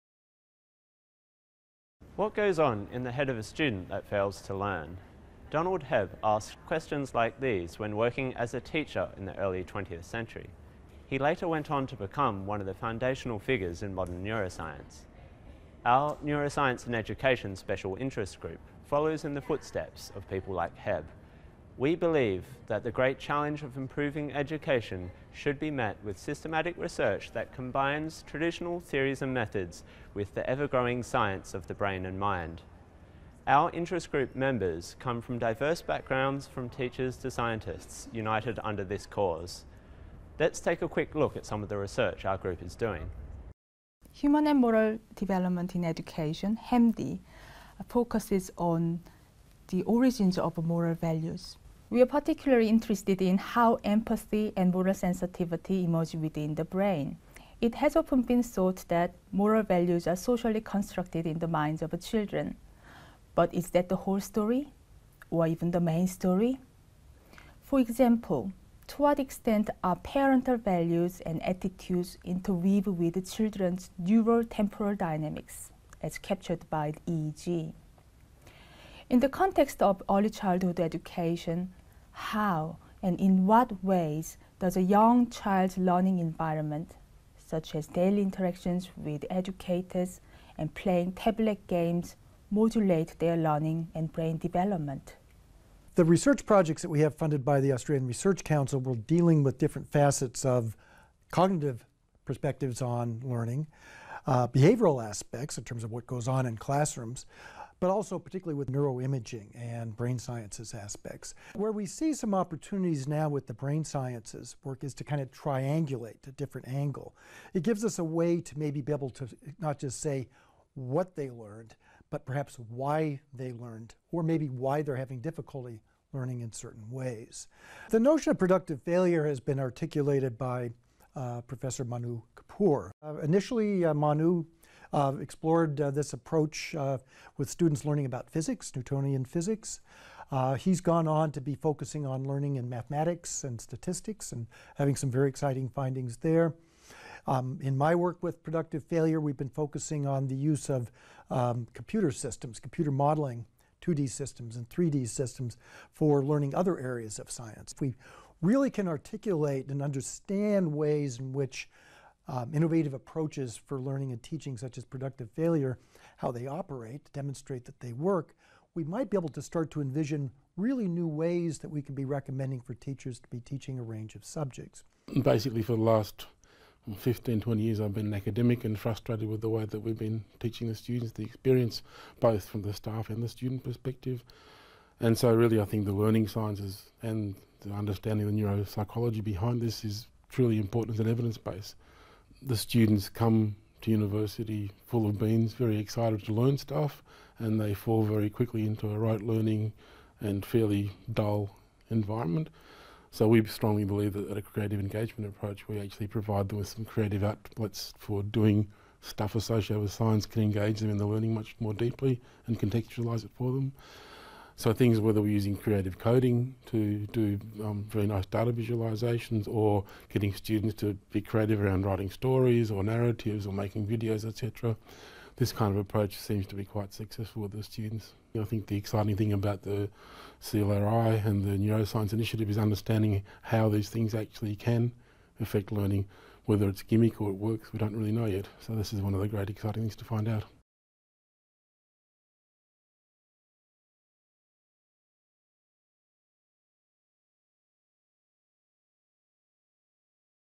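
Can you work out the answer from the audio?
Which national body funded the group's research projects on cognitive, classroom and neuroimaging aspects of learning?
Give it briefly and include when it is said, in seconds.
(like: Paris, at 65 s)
Australian Research Council, at 97 s.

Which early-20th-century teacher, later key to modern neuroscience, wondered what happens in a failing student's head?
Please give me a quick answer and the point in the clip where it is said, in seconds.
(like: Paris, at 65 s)
Donald Hebb, at 5 s.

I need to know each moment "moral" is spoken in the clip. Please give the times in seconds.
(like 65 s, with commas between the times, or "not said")
44 s, 50 s, 54 s, 59 s.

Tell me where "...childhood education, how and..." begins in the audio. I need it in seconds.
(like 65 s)
80 s.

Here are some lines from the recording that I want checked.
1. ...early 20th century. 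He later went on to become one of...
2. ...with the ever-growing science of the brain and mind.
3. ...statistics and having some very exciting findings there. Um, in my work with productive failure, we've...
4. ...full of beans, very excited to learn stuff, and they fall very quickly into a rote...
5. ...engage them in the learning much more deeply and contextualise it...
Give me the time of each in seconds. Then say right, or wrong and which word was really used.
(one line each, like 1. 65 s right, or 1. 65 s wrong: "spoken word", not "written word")
1. 9 s right
2. 30 s right
3. 143 s right
4. 194 s right
5. 210 s right.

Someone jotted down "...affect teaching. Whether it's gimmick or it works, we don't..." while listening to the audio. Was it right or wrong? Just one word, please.
wrong.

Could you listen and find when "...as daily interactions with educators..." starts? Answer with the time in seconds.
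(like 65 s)
87 s.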